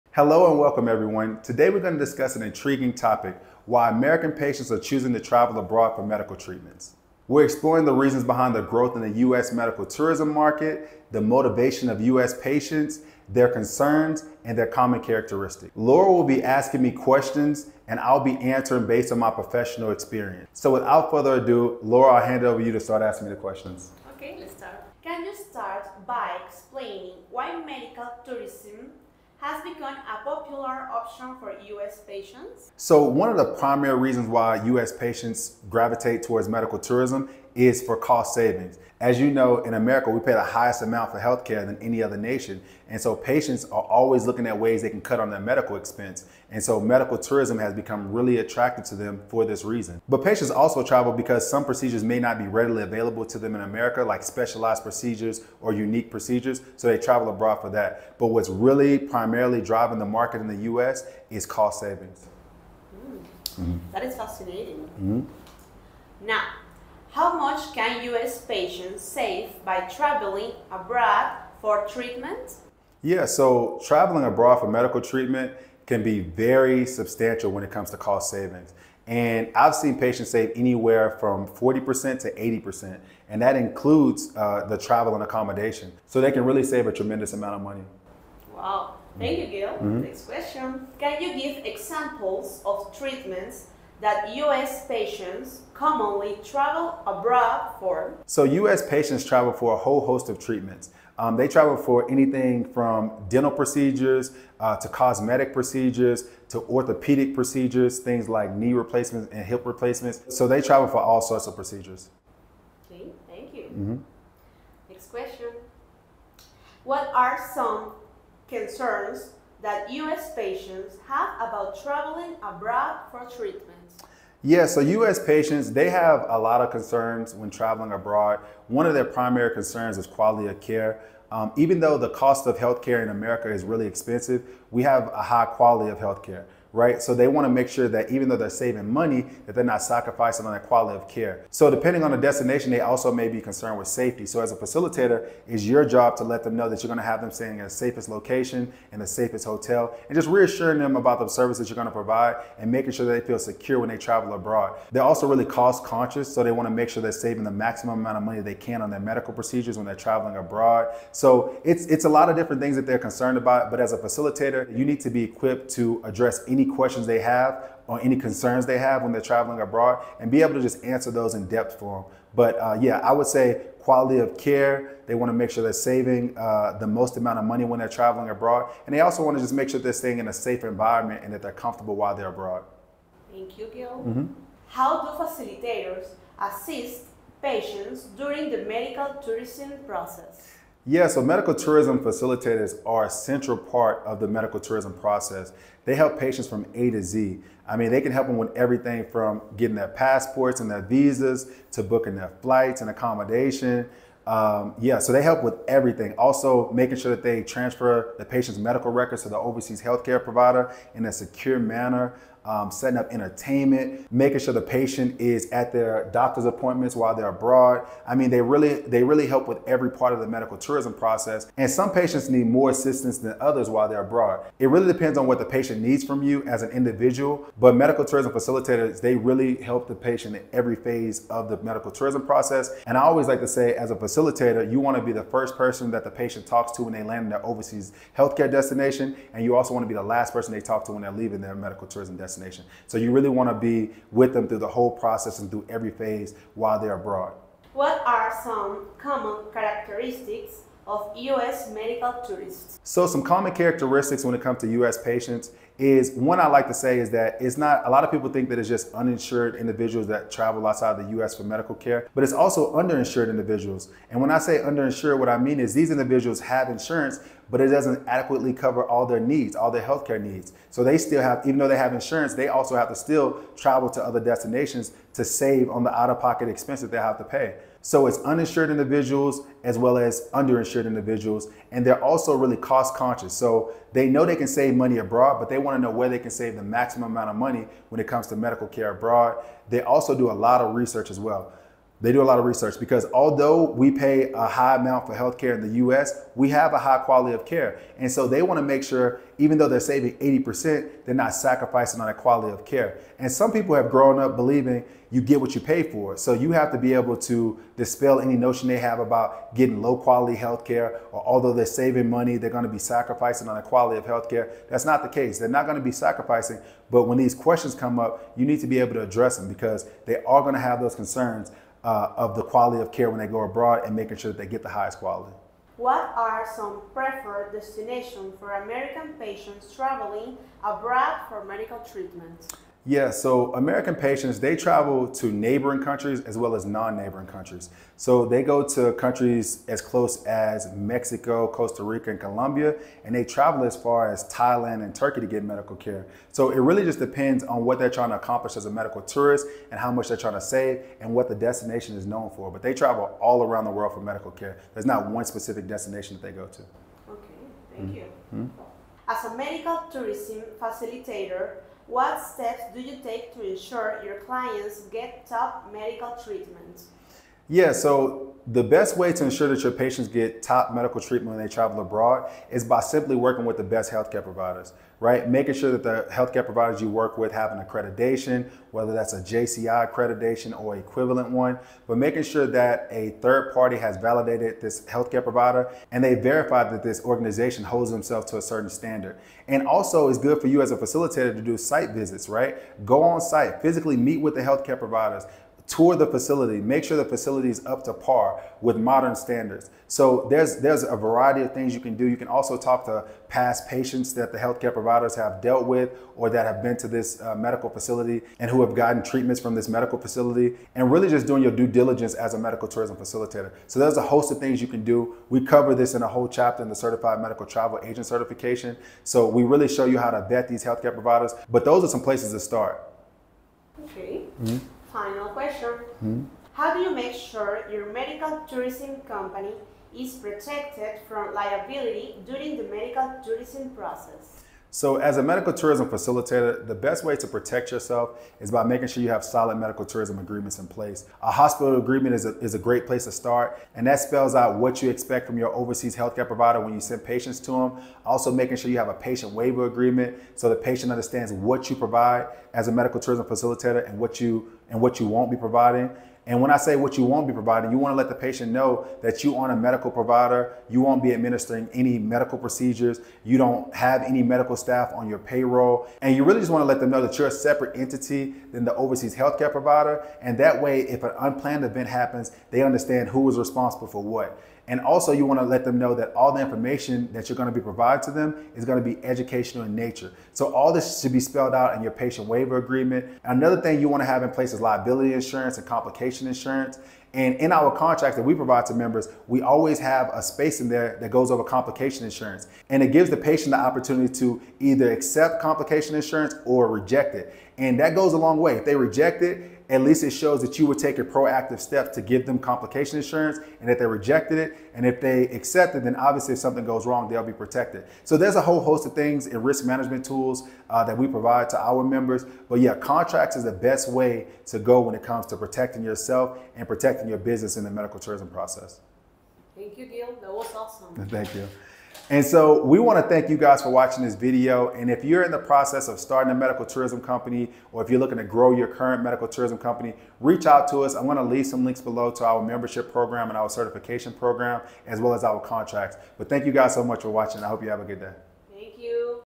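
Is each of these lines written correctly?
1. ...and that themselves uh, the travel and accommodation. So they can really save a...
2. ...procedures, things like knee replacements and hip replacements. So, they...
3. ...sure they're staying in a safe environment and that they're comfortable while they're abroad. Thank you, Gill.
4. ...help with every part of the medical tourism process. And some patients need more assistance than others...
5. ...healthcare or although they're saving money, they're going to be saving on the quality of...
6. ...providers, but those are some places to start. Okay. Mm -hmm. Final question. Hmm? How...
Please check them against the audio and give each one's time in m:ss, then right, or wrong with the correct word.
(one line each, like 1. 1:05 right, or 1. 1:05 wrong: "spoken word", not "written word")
1. 1:23 wrong: "includes", not "themselves"
2. 1:47 right
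3. 2:59 right
4. 3:39 right
5. 5:10 wrong: "sacrificing", not "saving"
6. 7:00 right.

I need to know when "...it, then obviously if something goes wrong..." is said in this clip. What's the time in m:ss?
8:25.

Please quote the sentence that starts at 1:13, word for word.
Yeah, so traveling abroad for medical treatment can be very substantial when it comes to cost savings.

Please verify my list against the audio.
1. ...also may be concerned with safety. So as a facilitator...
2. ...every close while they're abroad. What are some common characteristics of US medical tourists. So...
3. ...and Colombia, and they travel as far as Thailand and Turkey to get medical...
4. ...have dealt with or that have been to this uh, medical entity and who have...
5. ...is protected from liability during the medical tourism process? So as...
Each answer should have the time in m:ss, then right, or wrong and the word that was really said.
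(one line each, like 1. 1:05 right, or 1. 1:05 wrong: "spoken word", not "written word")
1. 2:22 right
2. 4:05 wrong: "phase", not "close"
3. 5:42 right
4. 6:45 wrong: "facility", not "entity"
5. 7:09 right.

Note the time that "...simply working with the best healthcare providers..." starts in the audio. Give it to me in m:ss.
6:12.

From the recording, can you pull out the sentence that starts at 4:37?
So it's uninsured individuals as well as underinsured individuals.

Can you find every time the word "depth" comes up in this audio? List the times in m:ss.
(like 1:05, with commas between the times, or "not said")
2:51.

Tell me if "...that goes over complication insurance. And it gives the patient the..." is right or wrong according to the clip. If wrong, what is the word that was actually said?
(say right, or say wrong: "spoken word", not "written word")
right.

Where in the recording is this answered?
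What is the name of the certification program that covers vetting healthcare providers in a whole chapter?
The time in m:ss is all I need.
6:56.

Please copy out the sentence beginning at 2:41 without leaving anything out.
So it's it's a lot of different things that they're concerned about.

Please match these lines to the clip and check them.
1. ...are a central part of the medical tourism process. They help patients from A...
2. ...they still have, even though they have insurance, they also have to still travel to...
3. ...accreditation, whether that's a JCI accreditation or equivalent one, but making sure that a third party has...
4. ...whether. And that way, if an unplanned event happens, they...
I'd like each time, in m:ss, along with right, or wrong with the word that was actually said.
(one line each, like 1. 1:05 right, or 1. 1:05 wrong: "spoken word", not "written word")
1. 3:12 right
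2. 4:30 right
3. 6:17 right
4. 7:49 wrong: "provider", not "whether".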